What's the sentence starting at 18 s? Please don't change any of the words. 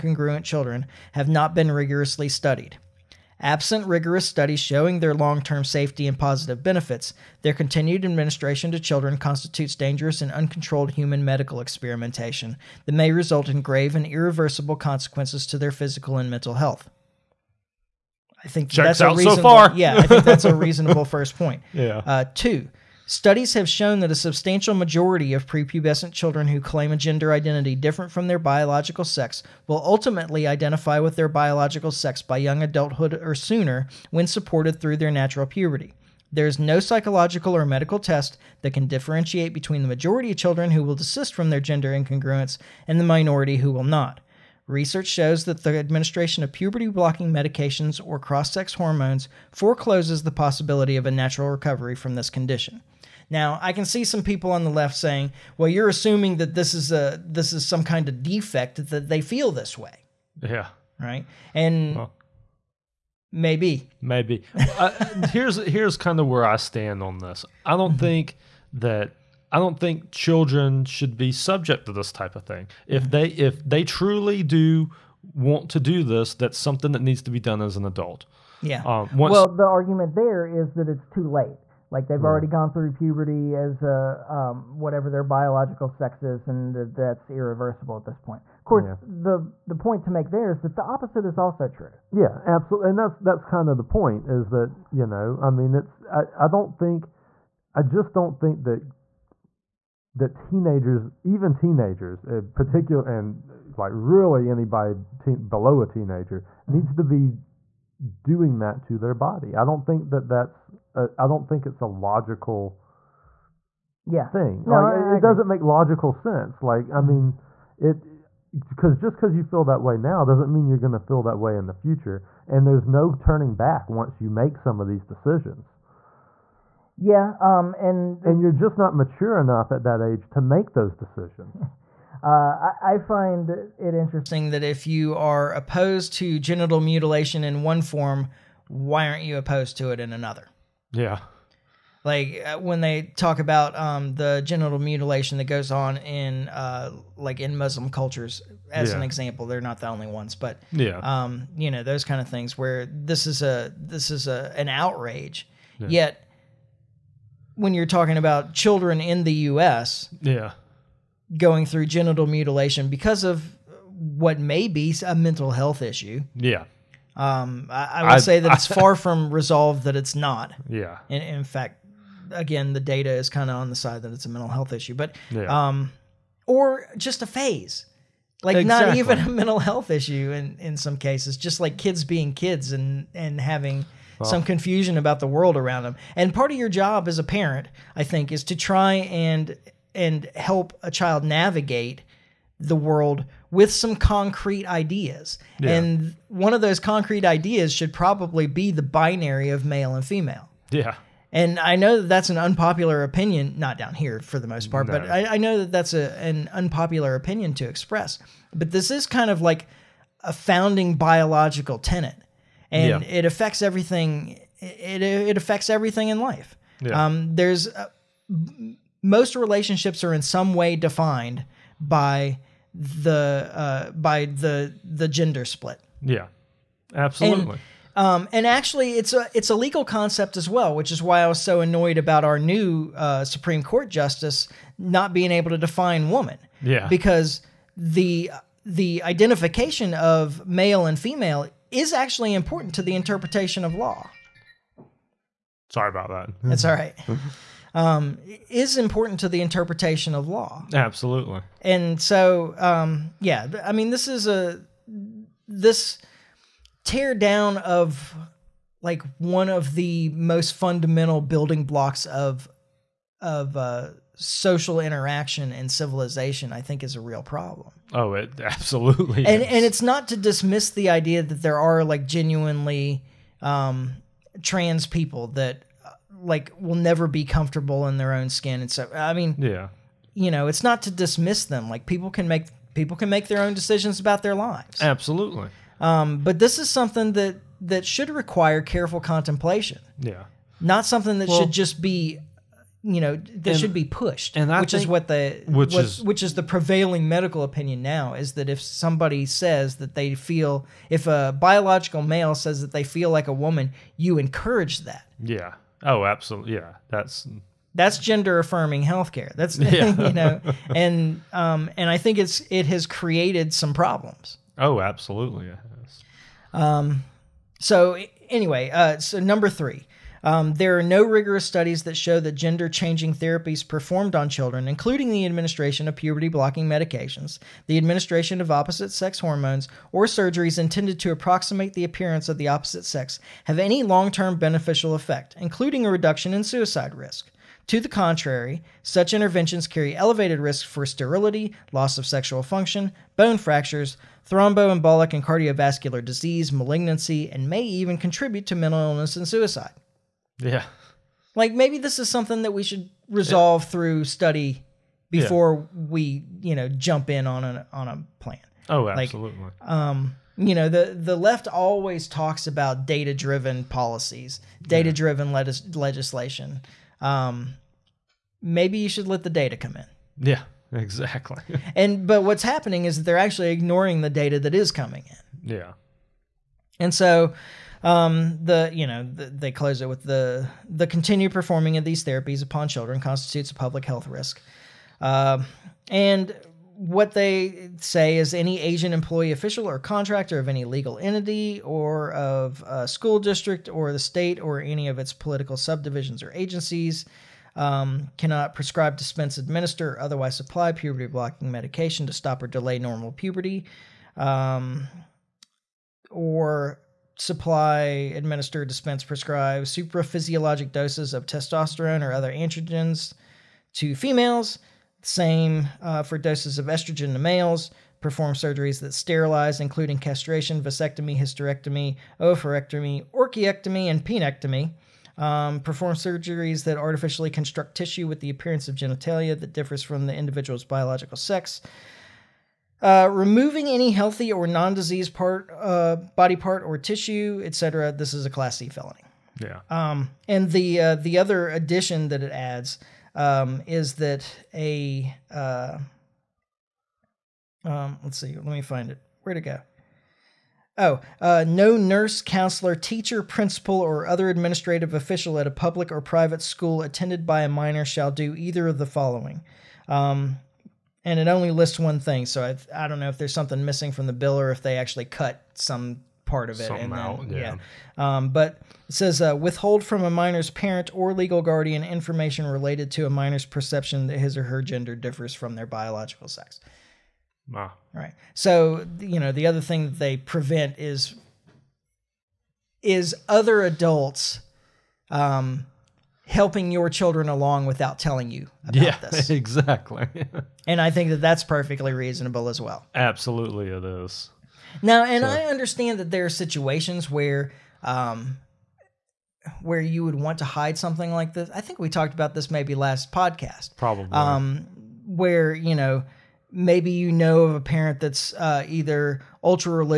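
I think Checks that's out a reasonable, so far.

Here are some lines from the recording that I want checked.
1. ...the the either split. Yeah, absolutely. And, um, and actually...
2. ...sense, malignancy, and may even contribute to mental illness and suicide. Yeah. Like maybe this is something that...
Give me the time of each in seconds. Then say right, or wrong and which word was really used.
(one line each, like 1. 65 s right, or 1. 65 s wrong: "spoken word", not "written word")
1. 224 s wrong: "gender", not "either"
2. 346 s wrong: "disease", not "sense".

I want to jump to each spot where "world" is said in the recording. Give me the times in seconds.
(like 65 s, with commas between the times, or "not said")
185 s, 192 s.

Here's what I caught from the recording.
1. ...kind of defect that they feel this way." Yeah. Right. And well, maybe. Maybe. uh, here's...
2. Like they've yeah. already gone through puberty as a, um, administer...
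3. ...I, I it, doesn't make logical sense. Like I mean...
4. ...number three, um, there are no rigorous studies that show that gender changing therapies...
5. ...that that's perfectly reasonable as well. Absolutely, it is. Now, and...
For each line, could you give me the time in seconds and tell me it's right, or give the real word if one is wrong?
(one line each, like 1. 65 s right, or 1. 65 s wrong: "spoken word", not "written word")
1. 57 s right
2. 81 s wrong: "whatever", not "administer"
3. 115 s right
4. 319 s right
5. 491 s right.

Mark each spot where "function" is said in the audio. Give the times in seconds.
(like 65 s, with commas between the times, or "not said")
342 s.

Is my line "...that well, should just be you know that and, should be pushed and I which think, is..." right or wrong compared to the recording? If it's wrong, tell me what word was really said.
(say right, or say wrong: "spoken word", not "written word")
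right.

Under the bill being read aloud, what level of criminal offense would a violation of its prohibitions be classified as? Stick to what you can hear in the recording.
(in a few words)
Class C felony.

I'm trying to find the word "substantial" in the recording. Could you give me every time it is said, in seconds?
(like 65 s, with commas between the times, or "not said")
24 s.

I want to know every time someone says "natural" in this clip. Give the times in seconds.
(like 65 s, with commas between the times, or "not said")
35 s, 51 s.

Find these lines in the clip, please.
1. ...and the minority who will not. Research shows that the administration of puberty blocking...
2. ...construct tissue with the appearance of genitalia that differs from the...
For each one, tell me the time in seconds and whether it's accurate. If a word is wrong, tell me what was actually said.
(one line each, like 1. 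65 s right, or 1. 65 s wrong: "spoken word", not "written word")
1. 42 s right
2. 427 s right.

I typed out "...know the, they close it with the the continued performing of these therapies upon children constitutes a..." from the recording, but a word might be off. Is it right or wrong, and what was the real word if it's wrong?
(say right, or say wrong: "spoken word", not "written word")
right.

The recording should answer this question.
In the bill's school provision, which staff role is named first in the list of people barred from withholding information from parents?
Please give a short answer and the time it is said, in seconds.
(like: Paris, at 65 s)
Nurse, at 451 s.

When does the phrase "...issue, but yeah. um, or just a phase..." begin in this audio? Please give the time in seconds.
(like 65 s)
174 s.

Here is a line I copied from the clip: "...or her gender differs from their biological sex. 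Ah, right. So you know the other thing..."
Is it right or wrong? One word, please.
right.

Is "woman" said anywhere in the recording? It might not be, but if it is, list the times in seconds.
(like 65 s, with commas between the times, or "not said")
236 s, 303 s.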